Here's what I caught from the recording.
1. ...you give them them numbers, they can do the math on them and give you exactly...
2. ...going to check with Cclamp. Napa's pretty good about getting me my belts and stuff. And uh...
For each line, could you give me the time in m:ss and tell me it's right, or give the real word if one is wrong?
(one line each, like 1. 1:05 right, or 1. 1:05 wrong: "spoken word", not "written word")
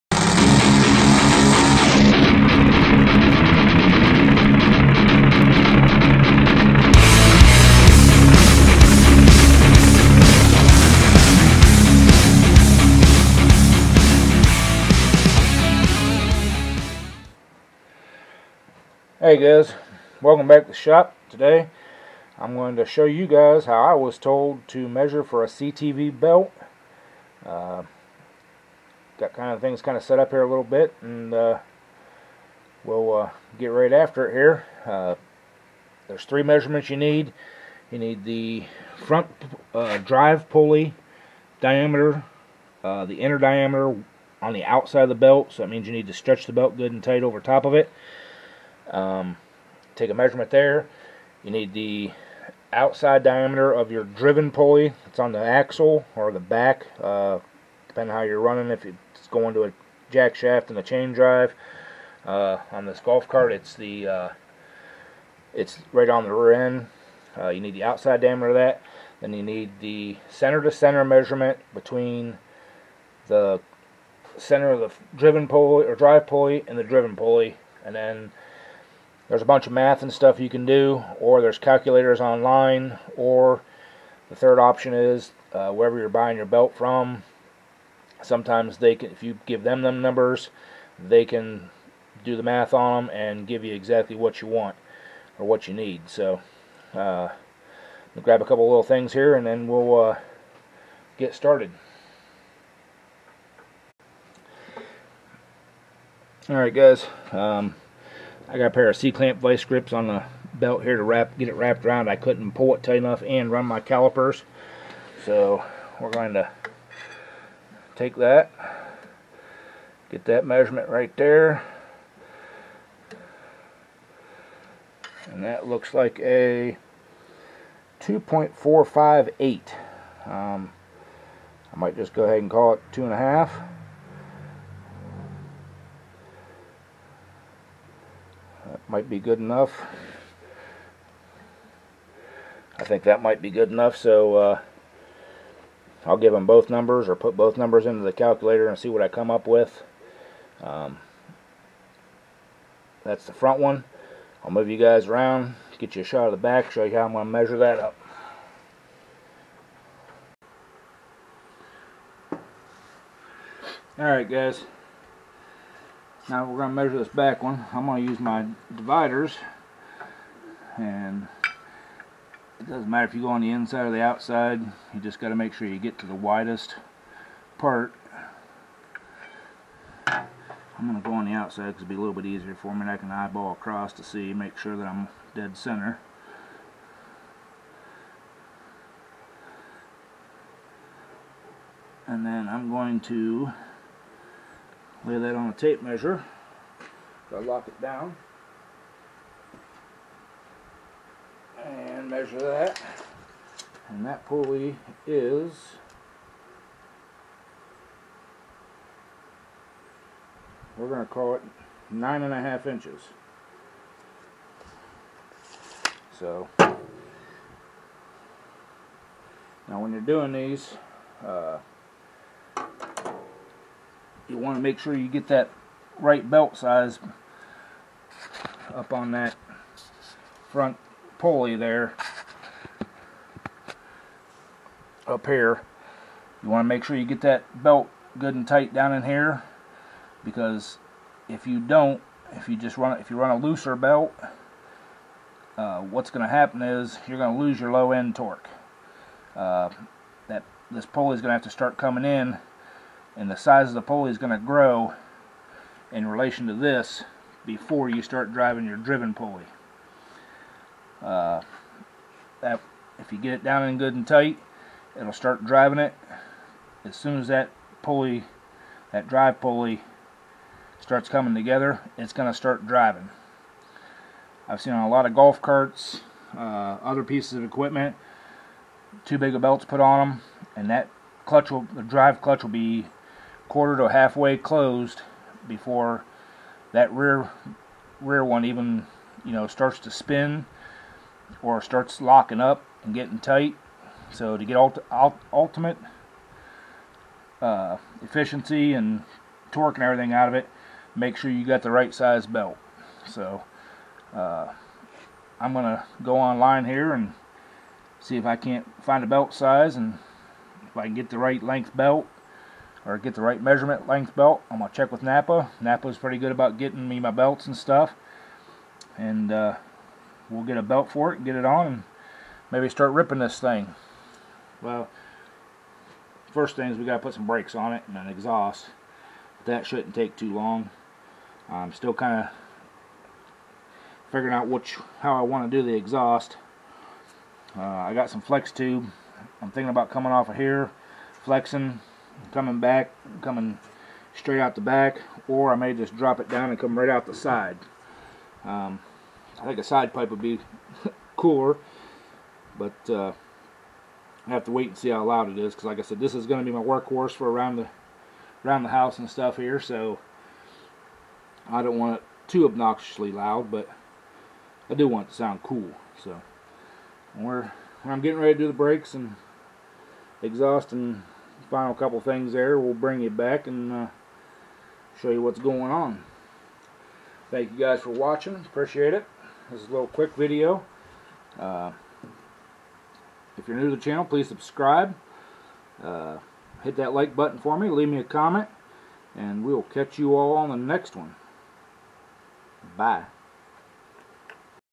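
1. 1:29 right
2. 5:14 wrong: "Napa", not "Cclamp".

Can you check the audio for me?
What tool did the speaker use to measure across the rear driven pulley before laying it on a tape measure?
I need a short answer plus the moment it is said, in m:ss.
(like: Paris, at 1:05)
dividers, at 2:48.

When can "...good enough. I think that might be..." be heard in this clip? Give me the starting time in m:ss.
2:19.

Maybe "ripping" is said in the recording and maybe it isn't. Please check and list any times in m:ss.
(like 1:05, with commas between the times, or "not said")
5:22.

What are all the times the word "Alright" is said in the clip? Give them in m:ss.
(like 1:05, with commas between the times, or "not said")
1:46, 2:43.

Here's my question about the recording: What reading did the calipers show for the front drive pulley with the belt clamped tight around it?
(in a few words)
2.458.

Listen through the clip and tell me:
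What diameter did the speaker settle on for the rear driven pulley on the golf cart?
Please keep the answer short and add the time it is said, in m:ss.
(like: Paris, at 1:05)
9.5 inches, at 3:31.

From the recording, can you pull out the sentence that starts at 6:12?
We'll bring you back and uh, show you what's going on.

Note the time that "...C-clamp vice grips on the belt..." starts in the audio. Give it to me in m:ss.
1:48.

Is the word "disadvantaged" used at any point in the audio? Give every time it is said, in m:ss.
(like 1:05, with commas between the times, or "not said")
not said.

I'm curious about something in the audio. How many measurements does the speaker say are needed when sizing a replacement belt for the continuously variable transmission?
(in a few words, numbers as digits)
3.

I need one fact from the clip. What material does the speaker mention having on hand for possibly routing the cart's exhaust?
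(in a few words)
flex tube.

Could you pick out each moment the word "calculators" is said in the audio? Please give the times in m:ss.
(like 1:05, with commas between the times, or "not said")
1:21, 2:28.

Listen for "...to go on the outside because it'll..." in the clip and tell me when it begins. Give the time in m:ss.
3:01.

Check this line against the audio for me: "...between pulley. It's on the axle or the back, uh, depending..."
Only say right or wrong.
wrong.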